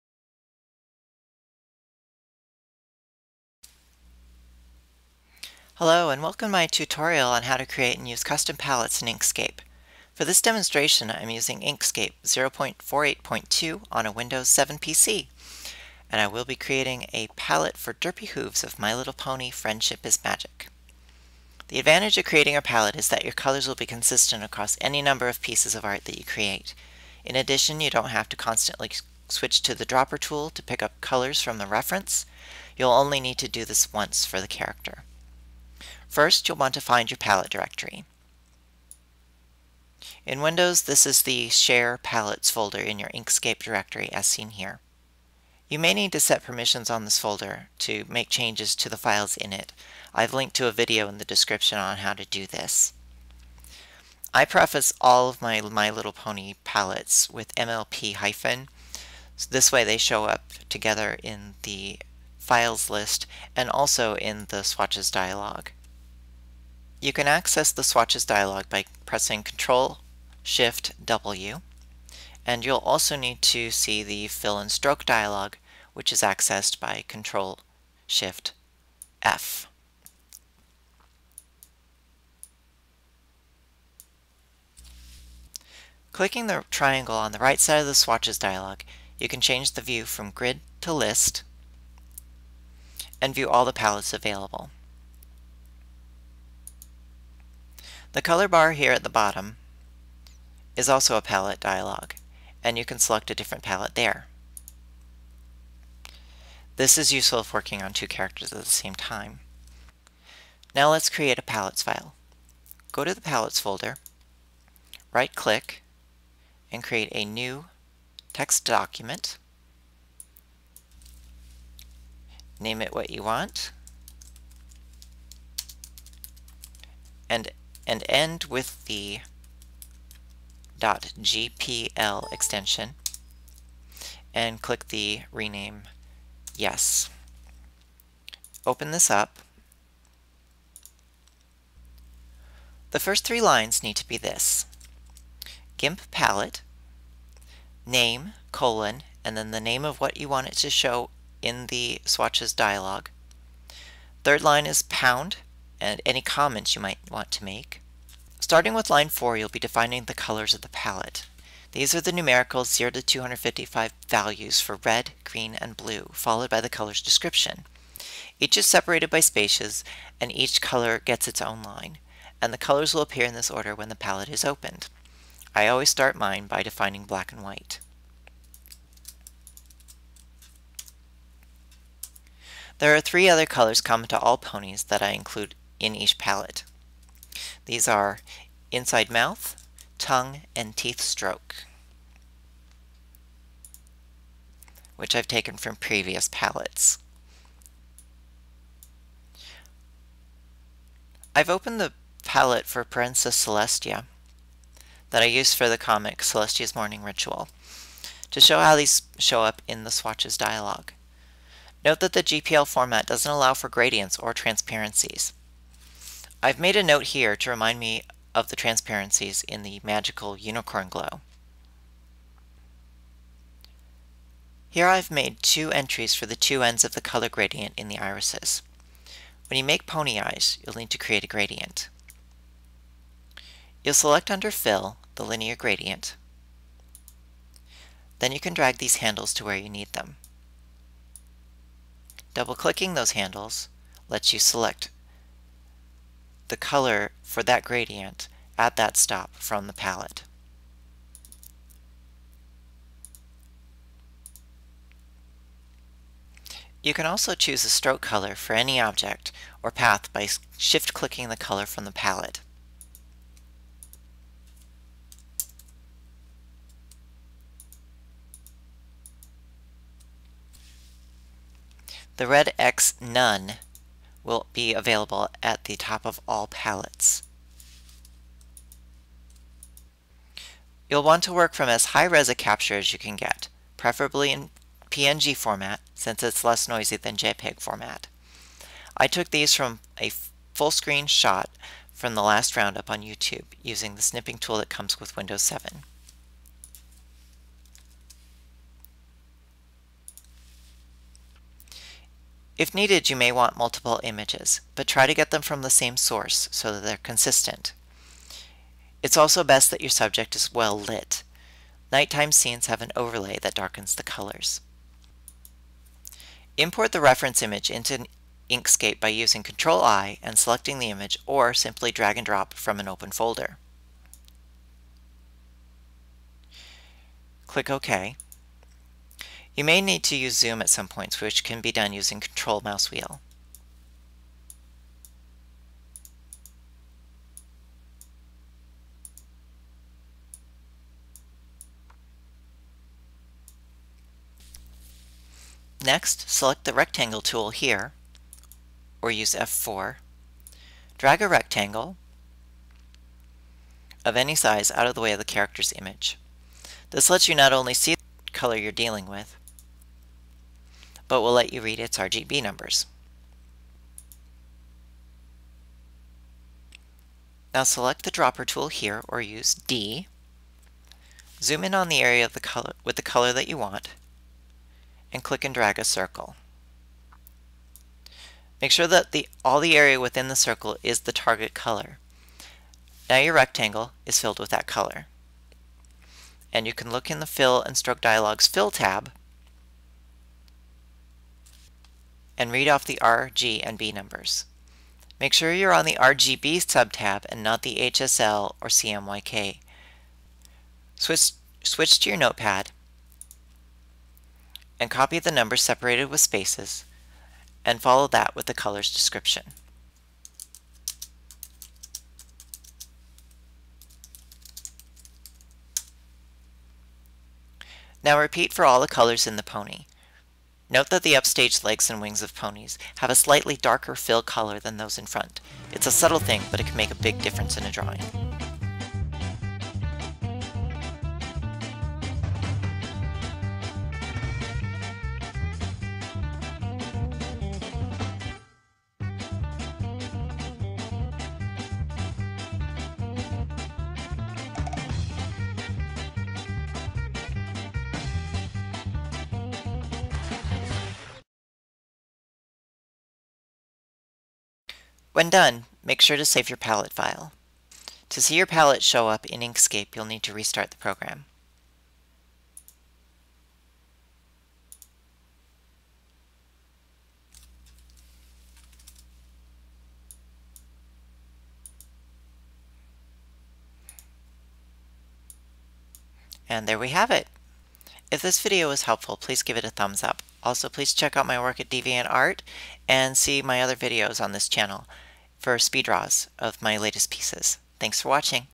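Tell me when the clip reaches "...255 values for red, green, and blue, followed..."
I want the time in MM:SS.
02:43.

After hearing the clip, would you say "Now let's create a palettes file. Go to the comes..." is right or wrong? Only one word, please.
wrong.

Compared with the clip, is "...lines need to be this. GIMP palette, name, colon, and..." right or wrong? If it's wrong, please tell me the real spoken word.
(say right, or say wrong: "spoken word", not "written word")
right.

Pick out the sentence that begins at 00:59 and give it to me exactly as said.
So this way they show up together in the files list and also in the swatches dialog.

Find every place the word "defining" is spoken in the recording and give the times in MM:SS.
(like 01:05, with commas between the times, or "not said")
02:39, 02:56.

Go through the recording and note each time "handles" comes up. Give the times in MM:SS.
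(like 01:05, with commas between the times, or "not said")
03:58, 04:03.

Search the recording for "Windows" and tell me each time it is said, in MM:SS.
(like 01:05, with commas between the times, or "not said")
00:14, 00:40, 04:55.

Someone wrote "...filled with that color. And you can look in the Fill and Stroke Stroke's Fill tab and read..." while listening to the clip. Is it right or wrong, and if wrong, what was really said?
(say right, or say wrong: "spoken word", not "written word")
wrong: "Dialog", not "Stroke".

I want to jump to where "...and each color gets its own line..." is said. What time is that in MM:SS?
02:50.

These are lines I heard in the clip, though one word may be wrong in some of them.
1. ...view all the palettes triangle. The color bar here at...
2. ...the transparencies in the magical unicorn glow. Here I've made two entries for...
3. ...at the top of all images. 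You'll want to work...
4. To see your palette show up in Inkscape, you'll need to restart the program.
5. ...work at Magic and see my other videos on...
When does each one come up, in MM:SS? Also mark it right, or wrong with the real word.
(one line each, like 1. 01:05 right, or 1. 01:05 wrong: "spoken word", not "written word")
1. 01:33 wrong: "available", not "triangle"
2. 03:38 right
3. 04:35 wrong: "palettes", not "images"
4. 07:38 right
5. 08:01 wrong: "DeviantArt", not "Magic".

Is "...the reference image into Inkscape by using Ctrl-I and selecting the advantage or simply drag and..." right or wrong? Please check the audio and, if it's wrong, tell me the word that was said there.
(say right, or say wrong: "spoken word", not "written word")
wrong: "image", not "advantage".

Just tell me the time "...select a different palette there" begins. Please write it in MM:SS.
01:42.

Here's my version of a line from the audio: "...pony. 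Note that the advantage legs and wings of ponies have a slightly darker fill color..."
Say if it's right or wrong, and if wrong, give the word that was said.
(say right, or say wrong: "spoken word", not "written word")
wrong: "upstage", not "advantage".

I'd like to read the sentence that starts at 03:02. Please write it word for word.
There are three other colors common to all ponies that I include in each palette.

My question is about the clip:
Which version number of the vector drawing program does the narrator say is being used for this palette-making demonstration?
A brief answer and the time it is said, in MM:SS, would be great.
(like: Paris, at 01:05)
0.48.2, at 00:12.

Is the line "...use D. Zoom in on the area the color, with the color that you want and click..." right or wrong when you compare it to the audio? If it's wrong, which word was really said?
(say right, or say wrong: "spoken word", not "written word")
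right.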